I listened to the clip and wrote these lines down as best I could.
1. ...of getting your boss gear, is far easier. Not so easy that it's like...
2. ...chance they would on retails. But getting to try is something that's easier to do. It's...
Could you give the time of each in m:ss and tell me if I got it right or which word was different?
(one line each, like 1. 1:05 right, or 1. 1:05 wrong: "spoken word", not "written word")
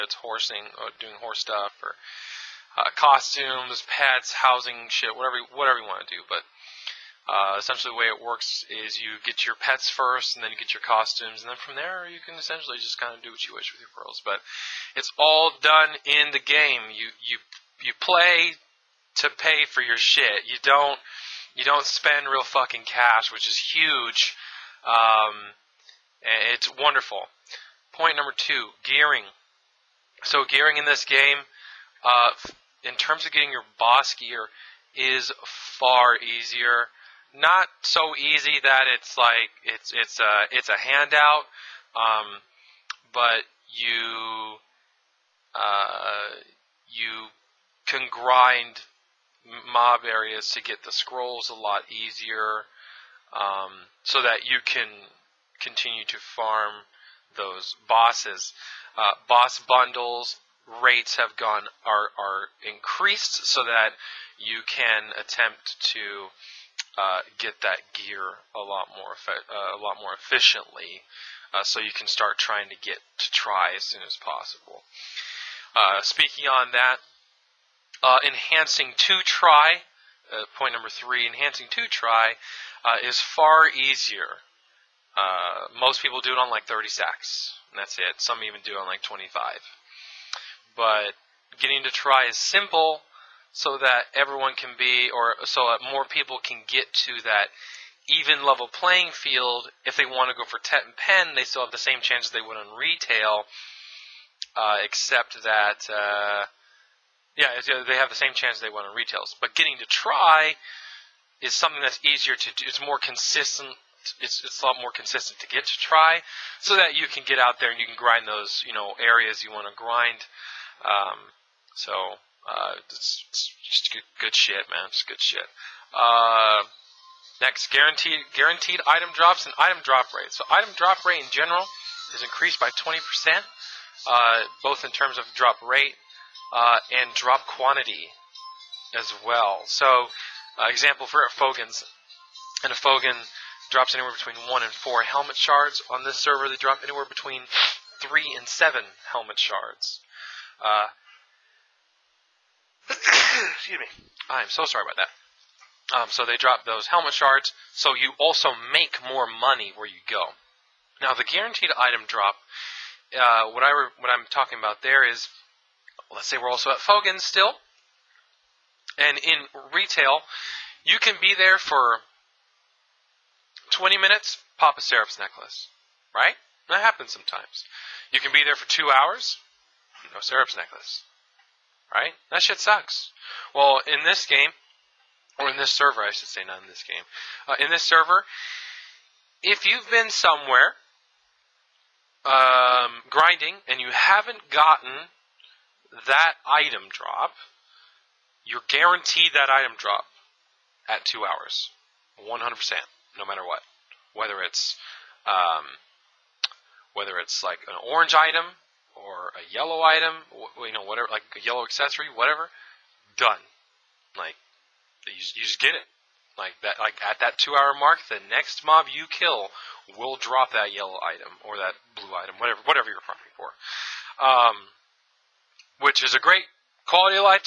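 1. 0:33 right
2. 1:48 right.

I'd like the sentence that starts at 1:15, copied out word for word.
Uh, speaking on that, uh, enhancing to try.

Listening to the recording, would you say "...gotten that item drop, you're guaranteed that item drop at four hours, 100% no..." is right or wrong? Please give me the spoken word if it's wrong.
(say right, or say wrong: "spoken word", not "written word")
wrong: "two", not "four".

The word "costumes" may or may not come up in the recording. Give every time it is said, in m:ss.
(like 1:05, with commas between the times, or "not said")
0:02, 0:10.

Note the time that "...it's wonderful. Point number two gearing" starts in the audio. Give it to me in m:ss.
0:26.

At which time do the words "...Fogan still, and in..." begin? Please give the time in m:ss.
2:46.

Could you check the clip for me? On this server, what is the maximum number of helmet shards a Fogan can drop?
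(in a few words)
7.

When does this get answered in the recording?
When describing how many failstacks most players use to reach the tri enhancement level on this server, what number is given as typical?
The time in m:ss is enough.
1:26.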